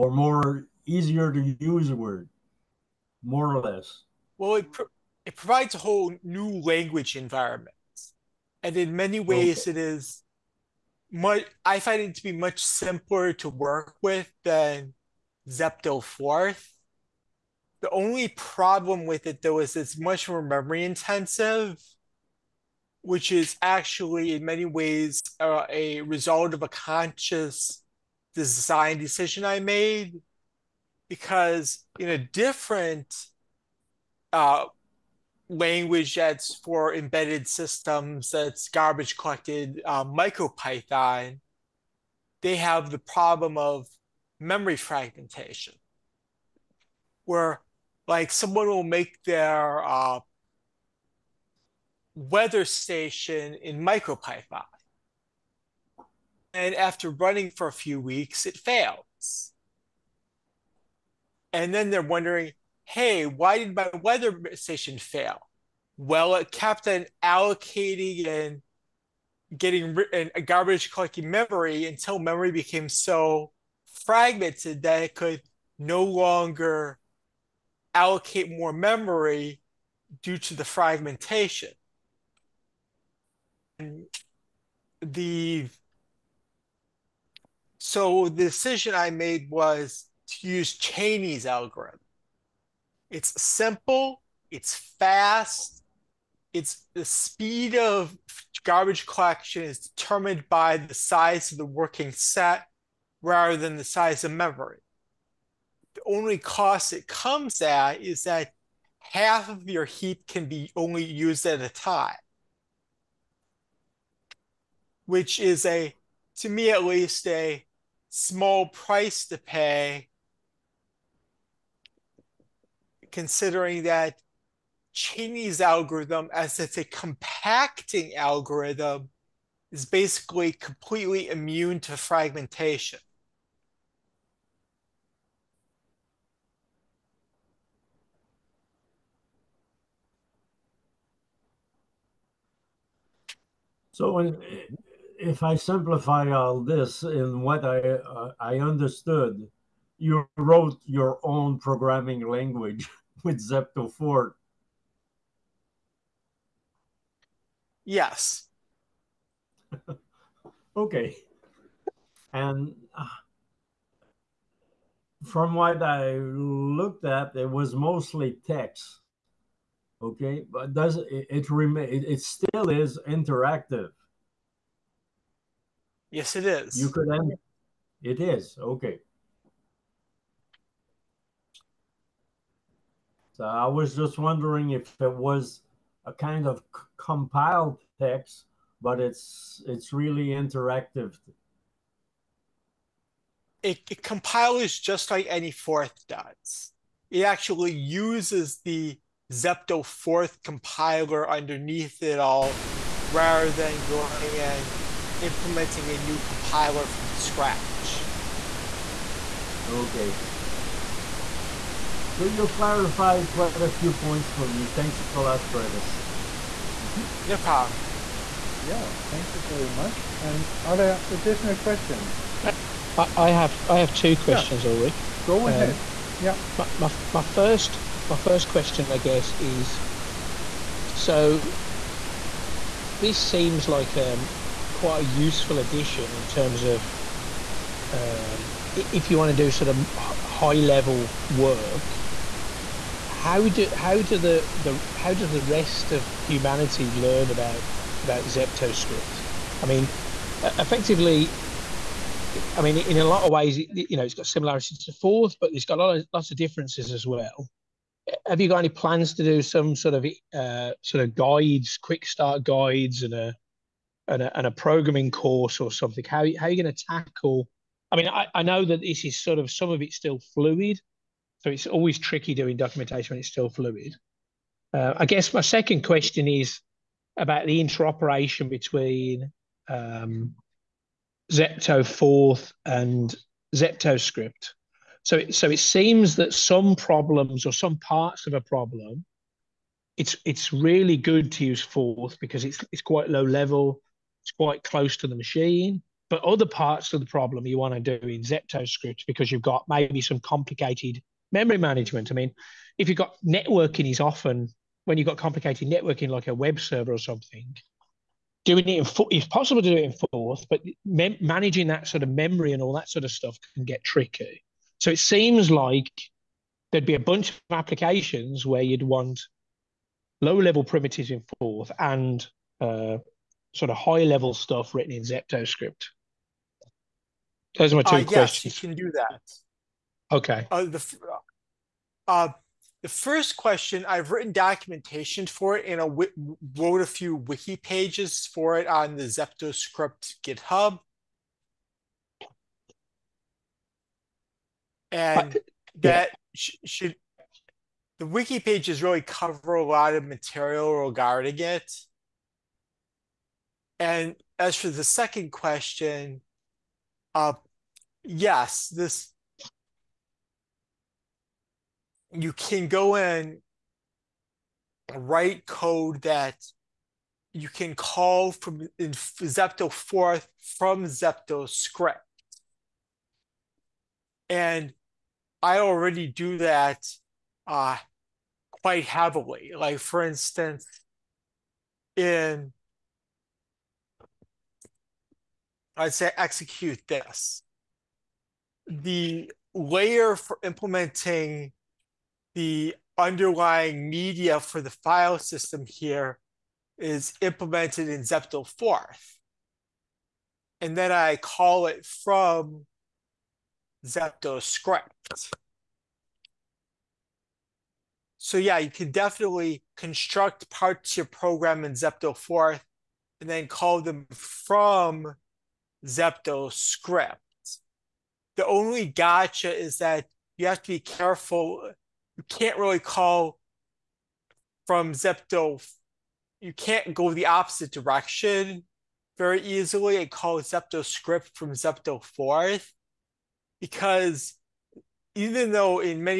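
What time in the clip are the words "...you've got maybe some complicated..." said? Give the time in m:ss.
4:59.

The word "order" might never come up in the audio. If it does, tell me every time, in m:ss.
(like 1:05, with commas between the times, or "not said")
not said.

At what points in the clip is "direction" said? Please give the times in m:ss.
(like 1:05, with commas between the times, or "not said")
7:07.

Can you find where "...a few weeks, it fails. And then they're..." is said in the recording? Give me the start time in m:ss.
0:57.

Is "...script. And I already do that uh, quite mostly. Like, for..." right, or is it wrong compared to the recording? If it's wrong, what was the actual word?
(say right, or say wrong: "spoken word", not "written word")
wrong: "heavily", not "mostly".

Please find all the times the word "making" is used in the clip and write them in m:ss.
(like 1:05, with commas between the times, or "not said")
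not said.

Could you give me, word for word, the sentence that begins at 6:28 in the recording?
The layer for implementing the underlying media for the file system here is implemented in Zepto 4th.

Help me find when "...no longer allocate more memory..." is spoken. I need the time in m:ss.
1:15.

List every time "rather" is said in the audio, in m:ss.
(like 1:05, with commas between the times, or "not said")
1:43, 3:23.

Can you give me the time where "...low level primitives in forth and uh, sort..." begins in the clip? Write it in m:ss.
5:20.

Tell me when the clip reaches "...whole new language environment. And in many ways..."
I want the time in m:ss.
0:05.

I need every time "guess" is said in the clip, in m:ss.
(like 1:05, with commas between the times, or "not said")
3:48, 4:35.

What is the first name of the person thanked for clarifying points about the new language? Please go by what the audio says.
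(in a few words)
Travis.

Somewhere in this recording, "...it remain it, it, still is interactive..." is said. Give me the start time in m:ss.
2:51.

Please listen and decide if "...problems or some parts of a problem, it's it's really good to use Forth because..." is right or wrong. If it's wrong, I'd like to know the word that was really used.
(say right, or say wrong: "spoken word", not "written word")
right.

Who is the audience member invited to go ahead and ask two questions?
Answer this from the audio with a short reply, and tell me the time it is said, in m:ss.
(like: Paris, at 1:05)
Ulrich, at 3:44.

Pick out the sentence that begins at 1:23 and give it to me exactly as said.
And the so the decision I made was to use Cheney's algorithm.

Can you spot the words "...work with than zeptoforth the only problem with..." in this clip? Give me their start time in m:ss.
0:13.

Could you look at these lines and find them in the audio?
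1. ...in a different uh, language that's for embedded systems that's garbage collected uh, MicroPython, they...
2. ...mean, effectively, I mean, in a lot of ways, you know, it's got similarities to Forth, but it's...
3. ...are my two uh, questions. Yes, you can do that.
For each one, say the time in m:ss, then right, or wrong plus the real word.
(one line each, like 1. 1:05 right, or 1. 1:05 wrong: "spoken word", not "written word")
1. 0:31 right
2. 4:09 right
3. 5:27 right.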